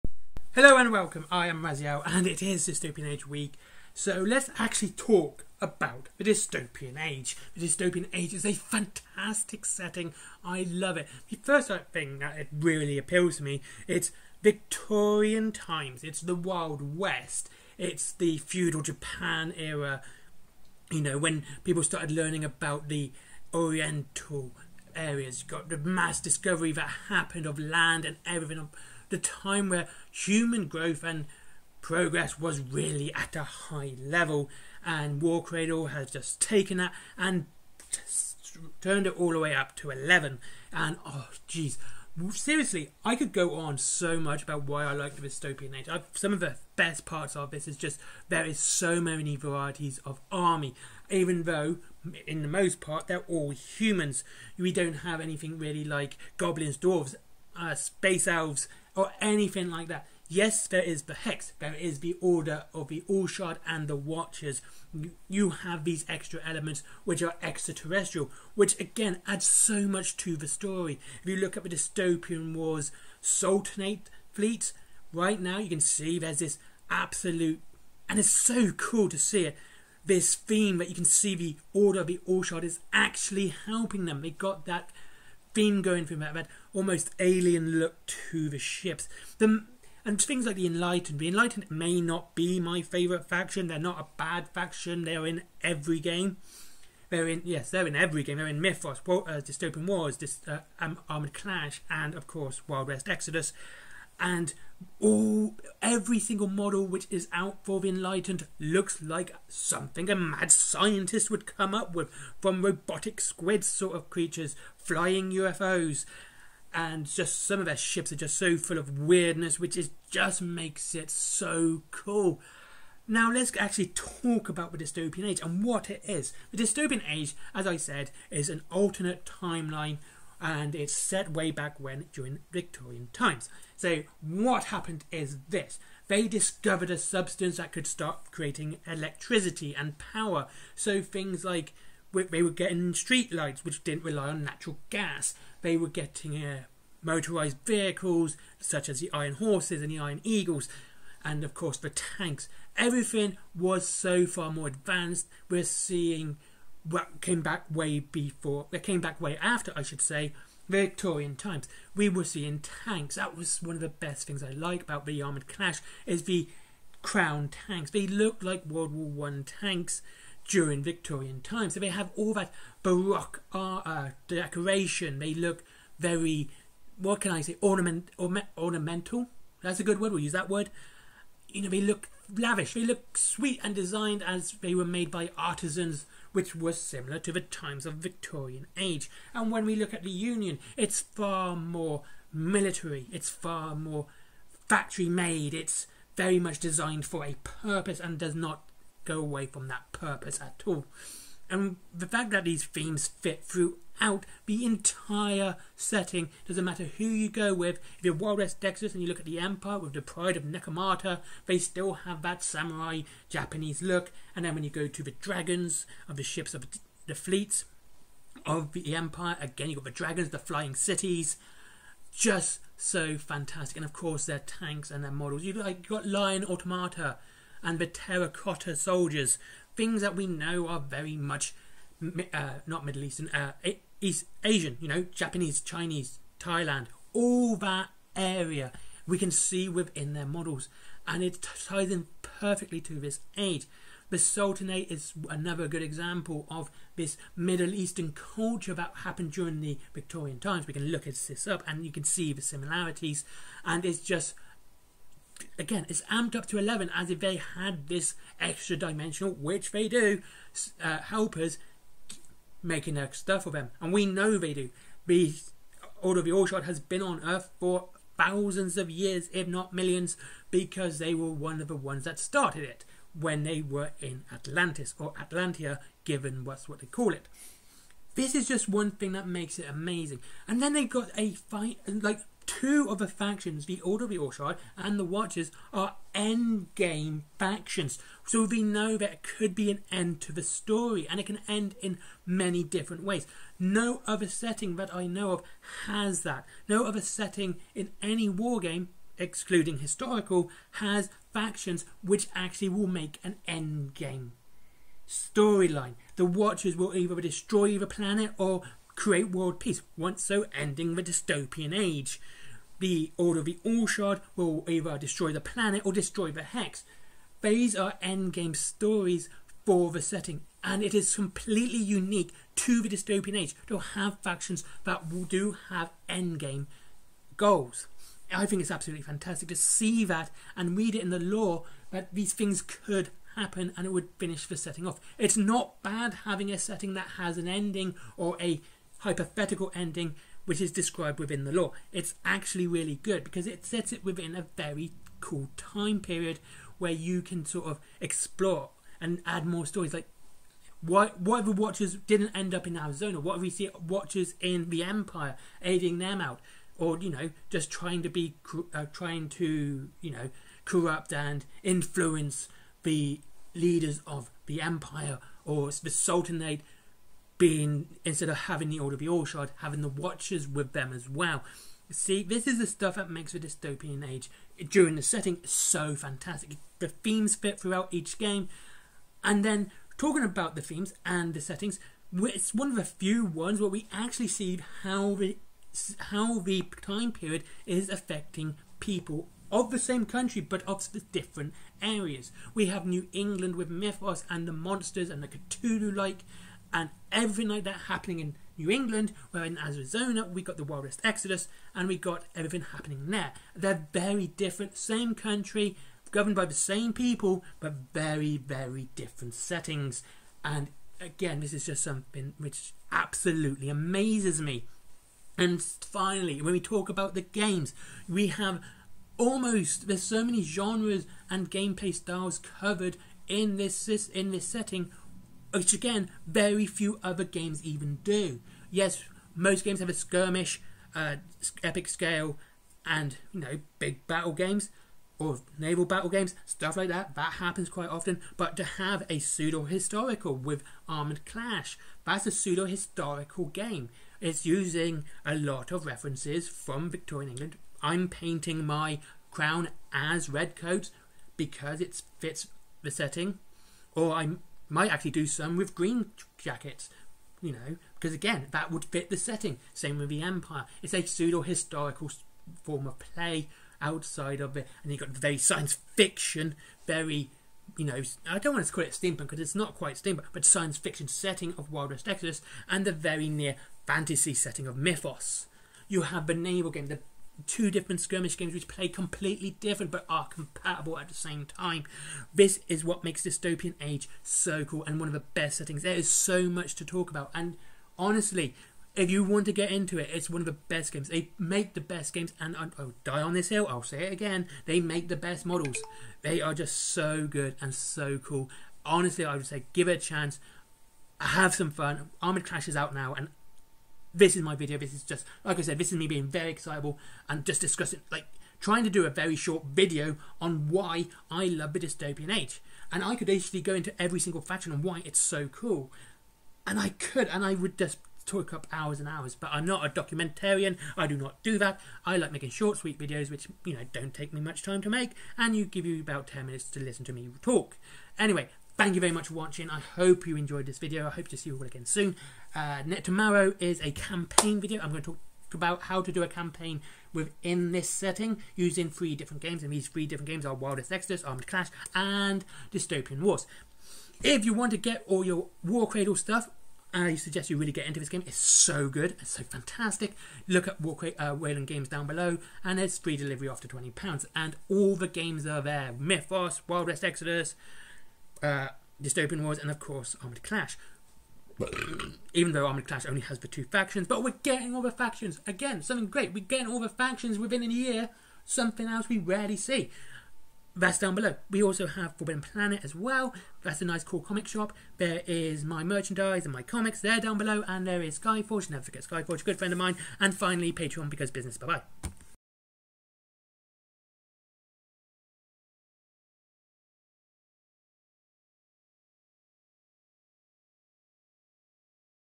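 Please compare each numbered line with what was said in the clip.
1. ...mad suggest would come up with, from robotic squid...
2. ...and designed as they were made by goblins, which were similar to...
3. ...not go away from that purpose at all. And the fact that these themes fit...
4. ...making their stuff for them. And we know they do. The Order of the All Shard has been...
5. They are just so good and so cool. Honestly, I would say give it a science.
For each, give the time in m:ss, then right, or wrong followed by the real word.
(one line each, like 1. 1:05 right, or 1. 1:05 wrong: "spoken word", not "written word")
1. 1:50 wrong: "scientist", not "suggest"
2. 3:03 wrong: "artisans", not "goblins"
3. 3:18 right
4. 4:22 right
5. 8:16 wrong: "chance", not "science".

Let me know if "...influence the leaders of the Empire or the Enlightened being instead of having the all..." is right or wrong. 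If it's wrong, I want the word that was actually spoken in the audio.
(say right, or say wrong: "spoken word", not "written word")
wrong: "Sultanate", not "Enlightened".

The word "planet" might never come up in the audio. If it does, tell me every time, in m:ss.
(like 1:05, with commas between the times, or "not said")
5:07, 5:15, 9:32.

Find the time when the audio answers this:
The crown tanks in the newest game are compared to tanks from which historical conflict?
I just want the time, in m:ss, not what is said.
2:48.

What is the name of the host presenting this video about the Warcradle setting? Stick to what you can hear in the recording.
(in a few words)
Raziel.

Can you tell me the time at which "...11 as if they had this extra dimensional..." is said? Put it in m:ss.
4:16.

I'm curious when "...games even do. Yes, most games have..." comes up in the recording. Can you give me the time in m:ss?
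7:07.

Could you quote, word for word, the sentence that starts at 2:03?
Now let's actually talk about the dystopian age and what it is.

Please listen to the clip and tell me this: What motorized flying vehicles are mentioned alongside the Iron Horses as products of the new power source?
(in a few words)
Iron Eagles.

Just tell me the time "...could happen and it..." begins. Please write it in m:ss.
5:32.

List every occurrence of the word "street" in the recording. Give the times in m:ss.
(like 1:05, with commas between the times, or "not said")
2:22.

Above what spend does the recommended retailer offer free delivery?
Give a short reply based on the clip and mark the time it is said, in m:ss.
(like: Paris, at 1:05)
£20, at 9:13.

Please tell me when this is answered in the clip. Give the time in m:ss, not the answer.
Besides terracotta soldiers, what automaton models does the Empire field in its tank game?
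3:46.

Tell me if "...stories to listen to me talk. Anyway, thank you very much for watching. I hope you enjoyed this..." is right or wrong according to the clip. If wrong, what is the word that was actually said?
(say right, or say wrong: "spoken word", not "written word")
wrong: "minutes", not "stories".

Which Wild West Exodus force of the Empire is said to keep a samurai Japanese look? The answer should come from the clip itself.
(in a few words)
Nekomata.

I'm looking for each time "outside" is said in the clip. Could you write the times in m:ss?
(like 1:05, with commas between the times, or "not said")
7:43.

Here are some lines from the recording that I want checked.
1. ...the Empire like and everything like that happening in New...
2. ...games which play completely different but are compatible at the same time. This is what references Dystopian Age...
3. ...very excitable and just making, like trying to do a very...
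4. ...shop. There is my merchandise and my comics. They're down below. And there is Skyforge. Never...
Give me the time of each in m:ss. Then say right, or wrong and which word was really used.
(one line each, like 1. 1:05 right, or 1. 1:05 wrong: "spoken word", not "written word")
1. 6:35 wrong: "Cthulhu", not "Empire"
2. 7:58 wrong: "makes", not "references"
3. 8:26 wrong: "discussing", not "making"
4. 9:34 right.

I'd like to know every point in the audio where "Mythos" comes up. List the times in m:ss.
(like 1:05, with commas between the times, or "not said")
1:38, 6:33, 7:54, 9:15.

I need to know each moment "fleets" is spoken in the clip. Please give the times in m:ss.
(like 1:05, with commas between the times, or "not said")
1:14, 3:37.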